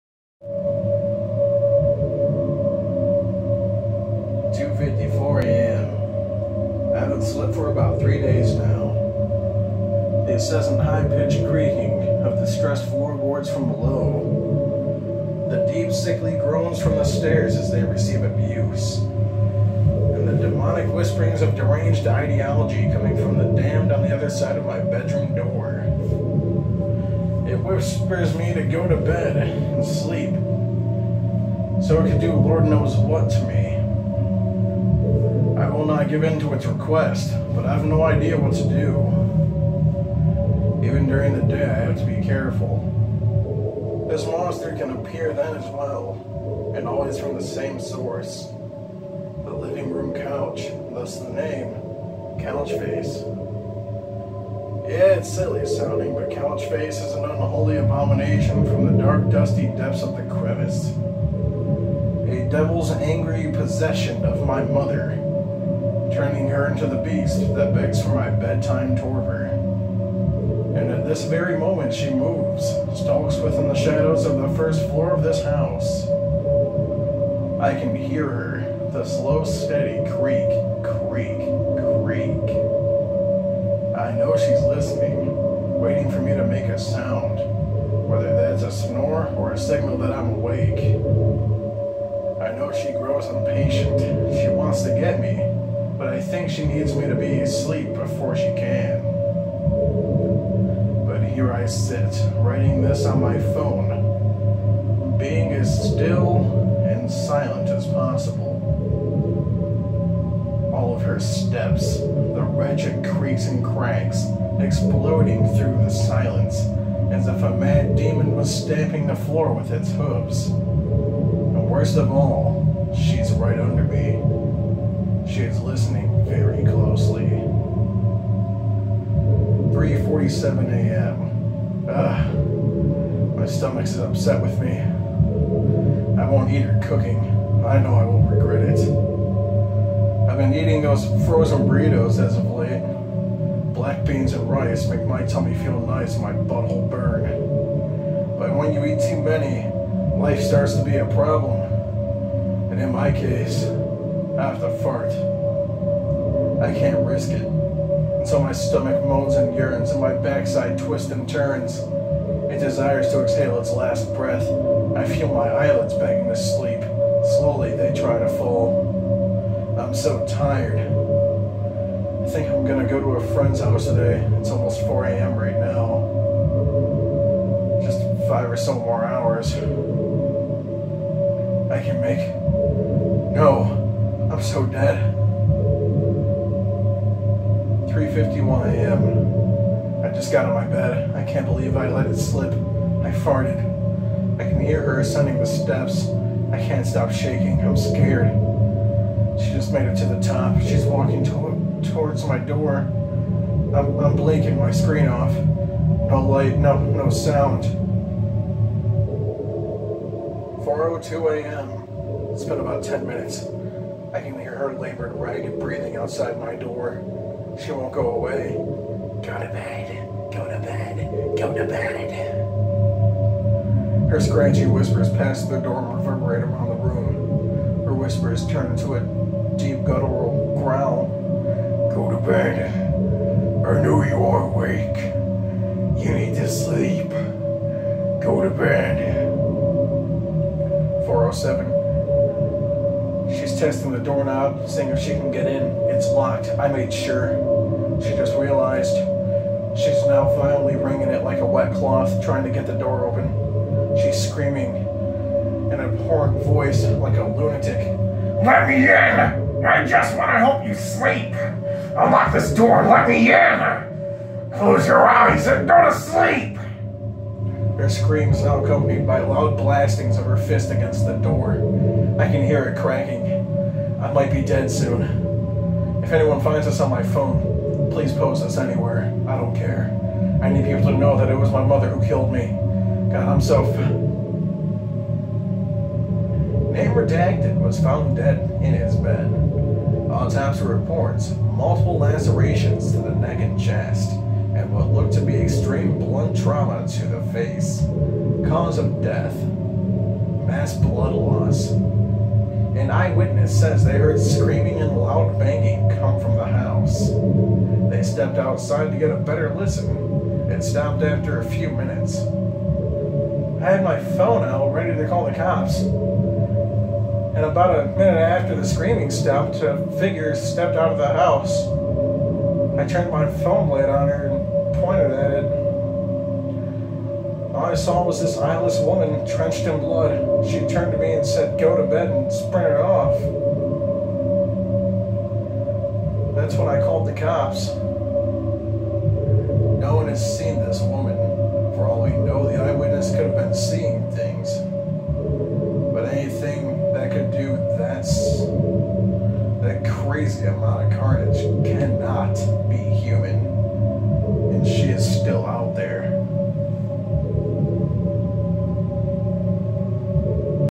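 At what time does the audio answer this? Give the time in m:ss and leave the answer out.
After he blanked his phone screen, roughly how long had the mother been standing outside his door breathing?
3:32.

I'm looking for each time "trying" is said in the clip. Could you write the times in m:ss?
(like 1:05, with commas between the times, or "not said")
4:12.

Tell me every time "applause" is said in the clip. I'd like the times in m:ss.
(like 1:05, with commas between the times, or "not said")
not said.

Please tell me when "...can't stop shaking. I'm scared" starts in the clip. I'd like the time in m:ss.
3:16.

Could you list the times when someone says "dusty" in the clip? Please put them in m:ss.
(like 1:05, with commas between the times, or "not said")
0:59.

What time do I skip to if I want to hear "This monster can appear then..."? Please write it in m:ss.
0:44.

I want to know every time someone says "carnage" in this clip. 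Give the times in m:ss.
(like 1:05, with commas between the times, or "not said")
5:50.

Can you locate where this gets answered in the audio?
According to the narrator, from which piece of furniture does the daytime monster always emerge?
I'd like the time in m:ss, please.
0:49.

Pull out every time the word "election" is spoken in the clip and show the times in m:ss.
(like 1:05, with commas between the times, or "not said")
not said.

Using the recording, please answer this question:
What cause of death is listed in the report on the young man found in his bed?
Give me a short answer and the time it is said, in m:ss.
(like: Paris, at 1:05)
mass blood loss, at 5:00.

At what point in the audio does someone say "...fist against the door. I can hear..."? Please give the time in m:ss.
4:30.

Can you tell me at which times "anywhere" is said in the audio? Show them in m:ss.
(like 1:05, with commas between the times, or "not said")
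4:38.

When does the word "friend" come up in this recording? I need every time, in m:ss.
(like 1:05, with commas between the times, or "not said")
2:53.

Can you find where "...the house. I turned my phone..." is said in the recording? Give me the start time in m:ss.
5:20.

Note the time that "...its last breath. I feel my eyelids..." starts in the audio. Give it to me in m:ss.
2:43.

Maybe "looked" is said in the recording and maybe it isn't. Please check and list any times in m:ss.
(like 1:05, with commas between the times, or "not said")
4:54.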